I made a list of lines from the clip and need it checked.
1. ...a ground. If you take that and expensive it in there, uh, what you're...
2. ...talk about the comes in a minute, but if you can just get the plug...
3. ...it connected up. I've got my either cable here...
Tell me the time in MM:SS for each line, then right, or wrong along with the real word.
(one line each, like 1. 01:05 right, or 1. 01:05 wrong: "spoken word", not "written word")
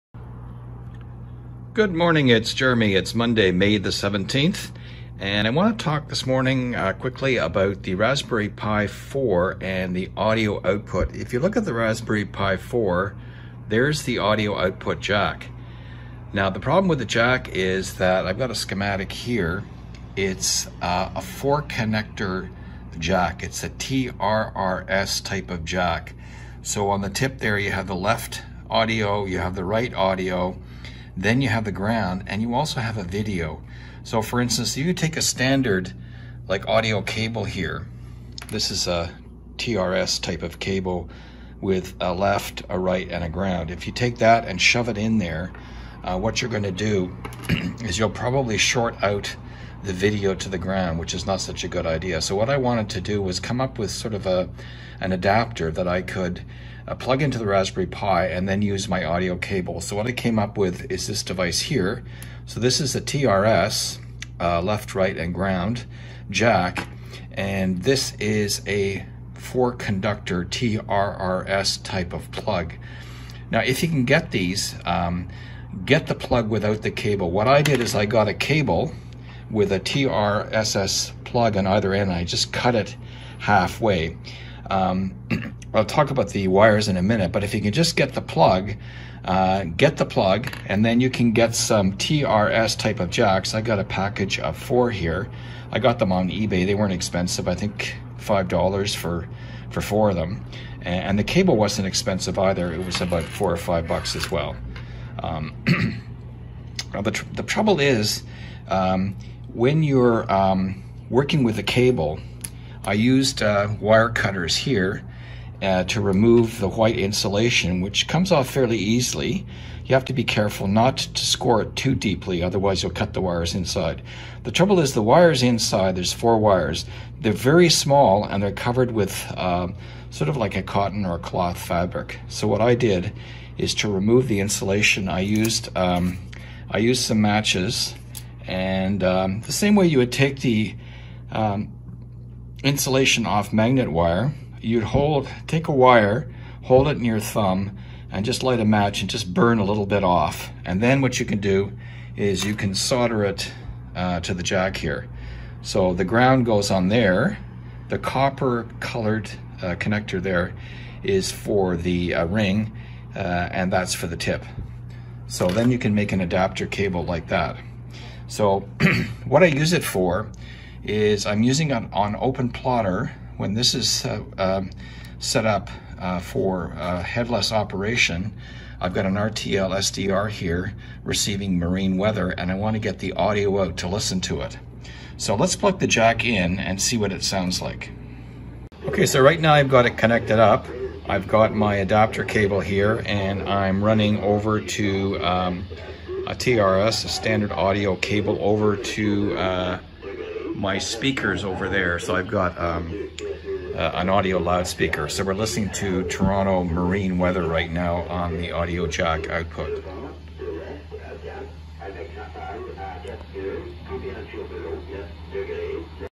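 1. 00:43 wrong: "shove", not "expensive"
2. 01:25 wrong: "wires", not "comes"
3. 03:09 wrong: "adapter", not "either".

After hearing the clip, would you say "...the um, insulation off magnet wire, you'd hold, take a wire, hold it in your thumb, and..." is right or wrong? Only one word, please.
right.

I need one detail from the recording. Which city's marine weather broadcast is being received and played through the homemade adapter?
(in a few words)
Toronto.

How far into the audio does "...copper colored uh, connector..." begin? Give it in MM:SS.
02:37.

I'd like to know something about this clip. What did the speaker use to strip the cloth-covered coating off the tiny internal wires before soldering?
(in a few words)
matches.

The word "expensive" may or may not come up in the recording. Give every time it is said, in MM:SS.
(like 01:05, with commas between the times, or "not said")
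01:36, 01:41.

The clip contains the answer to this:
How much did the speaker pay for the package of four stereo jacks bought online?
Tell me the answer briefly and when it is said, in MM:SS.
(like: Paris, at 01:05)
$5, at 01:38.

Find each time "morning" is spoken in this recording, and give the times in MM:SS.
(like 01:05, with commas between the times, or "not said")
00:01, 00:06.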